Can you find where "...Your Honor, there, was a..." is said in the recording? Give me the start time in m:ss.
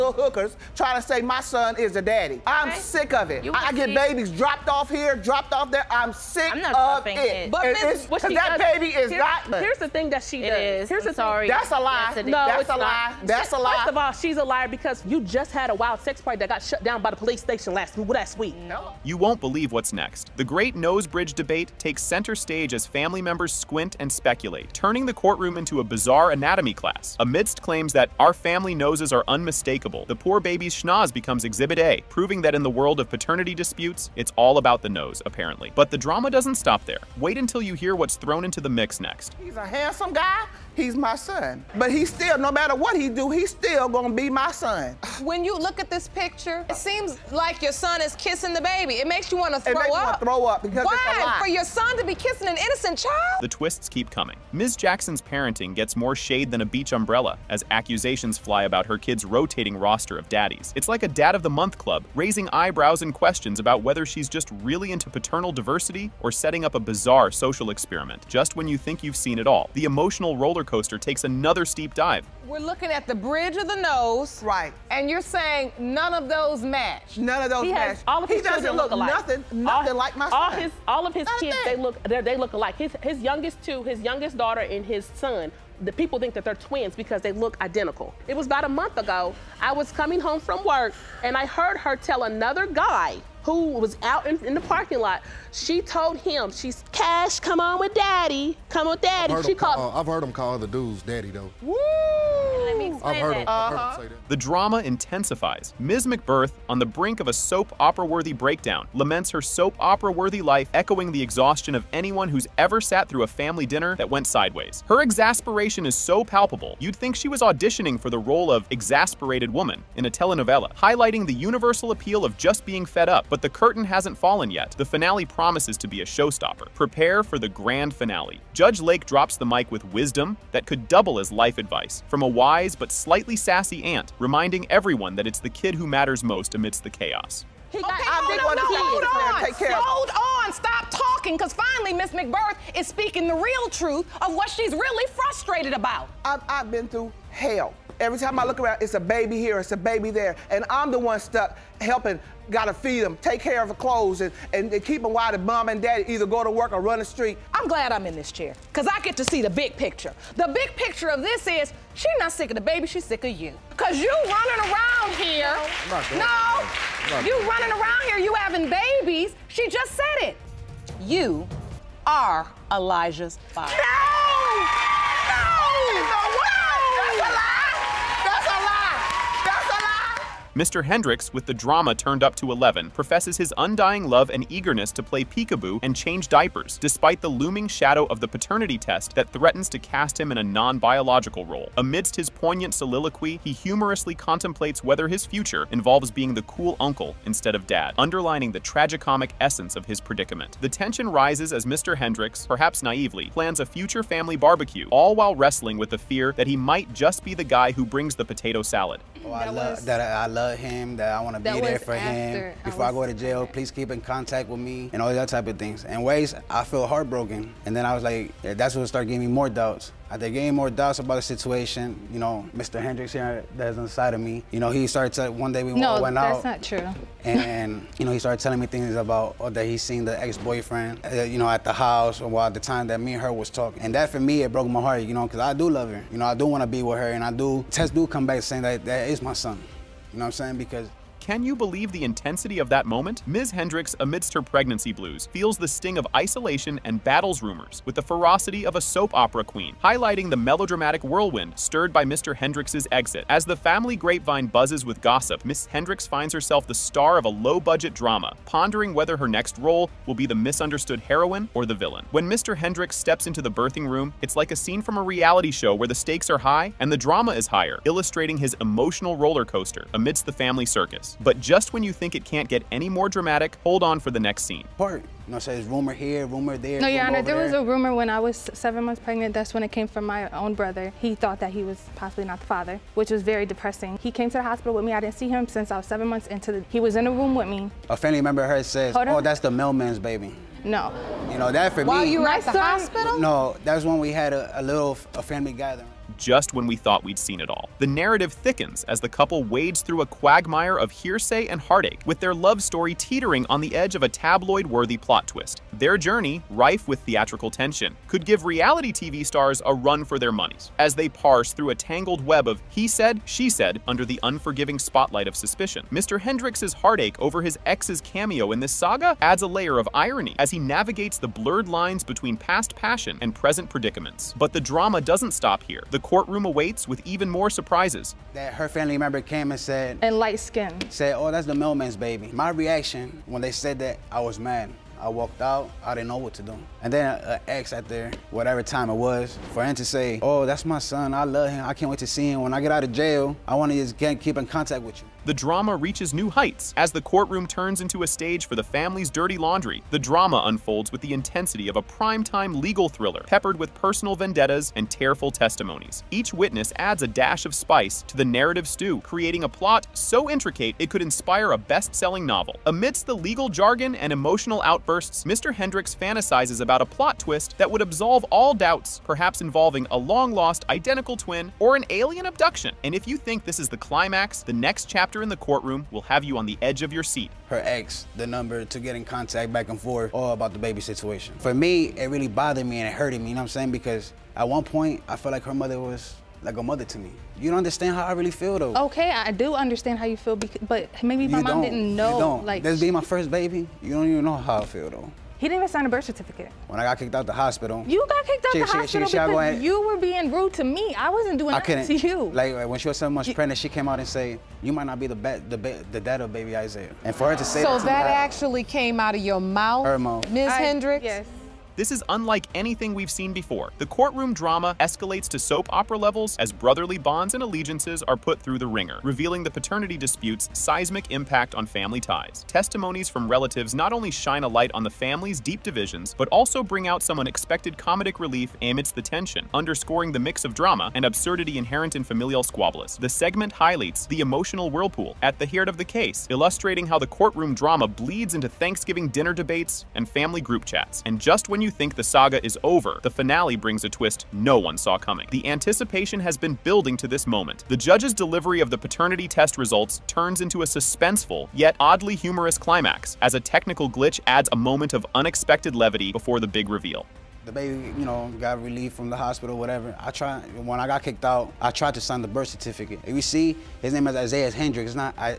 4:36.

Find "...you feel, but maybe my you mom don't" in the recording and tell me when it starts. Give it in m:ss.
6:30.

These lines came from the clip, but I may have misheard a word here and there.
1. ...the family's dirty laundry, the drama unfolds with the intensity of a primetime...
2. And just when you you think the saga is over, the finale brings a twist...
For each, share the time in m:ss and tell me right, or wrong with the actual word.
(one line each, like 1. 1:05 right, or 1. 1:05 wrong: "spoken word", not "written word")
1. 5:48 right
2. 7:21 right.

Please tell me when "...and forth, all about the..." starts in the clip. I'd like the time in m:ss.
6:19.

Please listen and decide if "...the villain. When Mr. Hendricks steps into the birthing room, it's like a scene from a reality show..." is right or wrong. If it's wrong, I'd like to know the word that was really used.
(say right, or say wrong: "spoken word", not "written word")
right.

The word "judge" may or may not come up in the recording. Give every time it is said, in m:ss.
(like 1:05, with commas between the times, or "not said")
2:08, 7:27.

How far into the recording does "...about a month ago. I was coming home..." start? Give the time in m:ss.
1:28.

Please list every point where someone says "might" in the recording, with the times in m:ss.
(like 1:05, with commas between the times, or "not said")
3:26, 6:44.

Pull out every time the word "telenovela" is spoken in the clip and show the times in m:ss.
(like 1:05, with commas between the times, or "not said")
2:00.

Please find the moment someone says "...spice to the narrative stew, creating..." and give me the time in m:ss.
5:57.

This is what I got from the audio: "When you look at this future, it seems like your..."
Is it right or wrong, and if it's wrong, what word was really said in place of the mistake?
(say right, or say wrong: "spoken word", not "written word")
wrong: "picture", not "future".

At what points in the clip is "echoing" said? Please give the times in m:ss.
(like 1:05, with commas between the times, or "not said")
1:50.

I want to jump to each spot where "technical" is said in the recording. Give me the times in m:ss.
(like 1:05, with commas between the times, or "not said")
7:33.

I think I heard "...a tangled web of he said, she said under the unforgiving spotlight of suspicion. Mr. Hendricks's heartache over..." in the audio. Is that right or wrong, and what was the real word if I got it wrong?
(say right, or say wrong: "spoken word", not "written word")
right.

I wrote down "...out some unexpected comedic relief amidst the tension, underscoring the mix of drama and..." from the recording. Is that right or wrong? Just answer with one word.
right.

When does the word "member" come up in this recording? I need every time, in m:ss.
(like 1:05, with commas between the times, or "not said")
0:23, 4:48, 5:28.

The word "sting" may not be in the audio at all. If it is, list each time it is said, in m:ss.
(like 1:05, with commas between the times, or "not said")
4:05.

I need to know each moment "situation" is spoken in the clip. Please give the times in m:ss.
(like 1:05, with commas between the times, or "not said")
3:41, 6:20.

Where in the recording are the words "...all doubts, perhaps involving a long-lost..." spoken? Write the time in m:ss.
6:08.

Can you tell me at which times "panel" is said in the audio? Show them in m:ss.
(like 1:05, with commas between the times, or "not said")
not said.